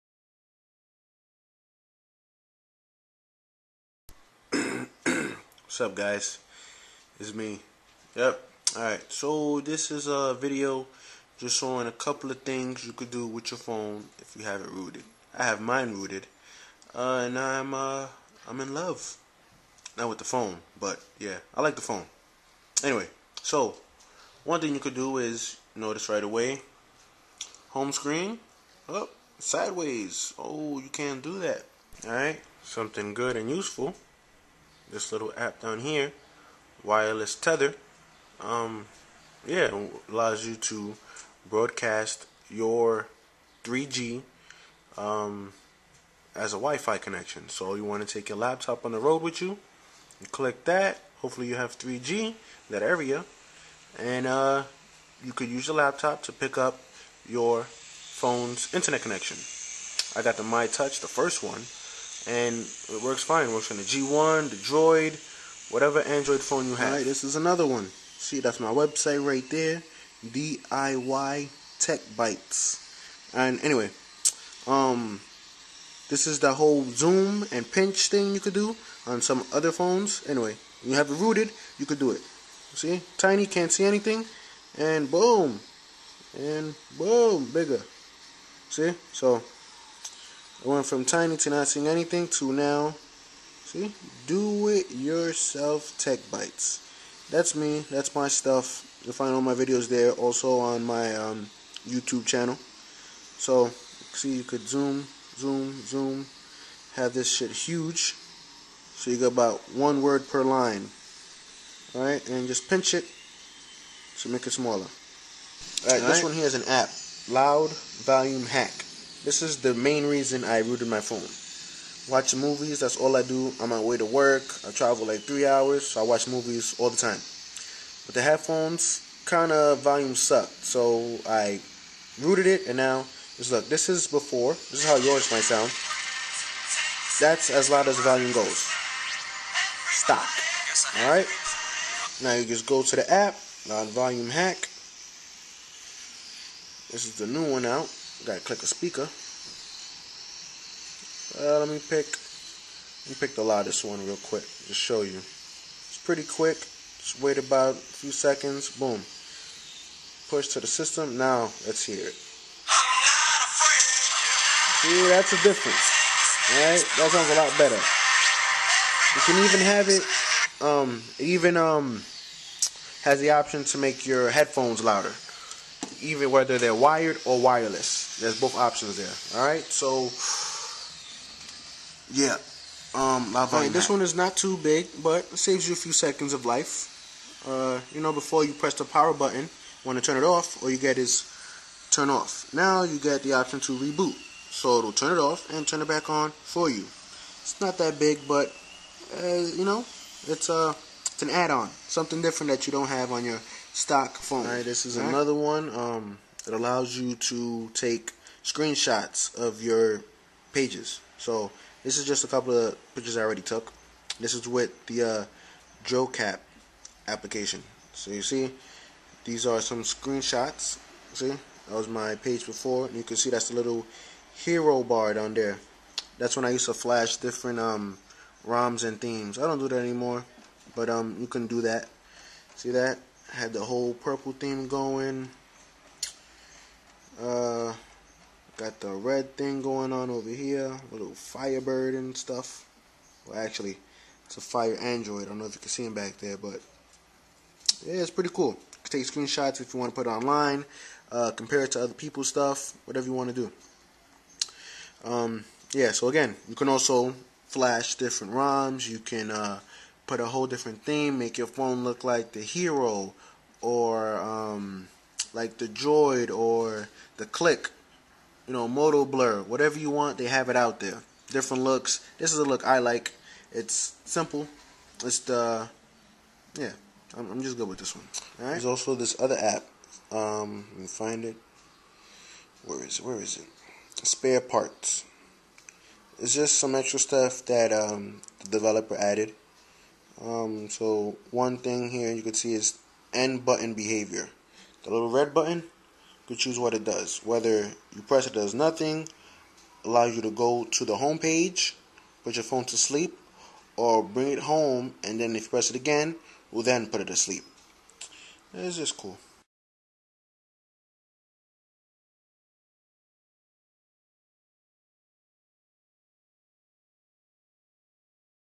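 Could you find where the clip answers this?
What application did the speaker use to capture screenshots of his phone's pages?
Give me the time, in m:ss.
3:35.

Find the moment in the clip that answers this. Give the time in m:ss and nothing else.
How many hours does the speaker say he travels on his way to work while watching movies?
2:05.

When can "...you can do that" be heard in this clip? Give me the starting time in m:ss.
3:51.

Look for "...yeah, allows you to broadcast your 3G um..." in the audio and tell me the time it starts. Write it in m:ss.
0:39.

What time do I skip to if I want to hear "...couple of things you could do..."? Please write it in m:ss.
0:11.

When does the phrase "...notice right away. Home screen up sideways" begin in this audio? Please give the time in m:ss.
0:25.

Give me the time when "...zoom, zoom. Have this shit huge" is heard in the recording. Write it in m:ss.
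1:45.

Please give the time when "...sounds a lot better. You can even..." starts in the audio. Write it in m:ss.
2:47.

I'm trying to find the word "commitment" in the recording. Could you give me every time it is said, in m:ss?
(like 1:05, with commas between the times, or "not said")
not said.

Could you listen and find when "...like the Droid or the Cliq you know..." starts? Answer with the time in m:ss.
4:25.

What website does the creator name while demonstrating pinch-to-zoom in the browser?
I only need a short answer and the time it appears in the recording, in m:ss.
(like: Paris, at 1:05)
DIY Tech Bites, at 1:10.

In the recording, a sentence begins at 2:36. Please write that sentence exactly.
Just wait about a few seconds.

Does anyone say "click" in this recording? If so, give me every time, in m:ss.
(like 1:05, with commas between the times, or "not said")
0:50, 2:28.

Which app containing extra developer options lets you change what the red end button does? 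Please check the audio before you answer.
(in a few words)
Spare Parts.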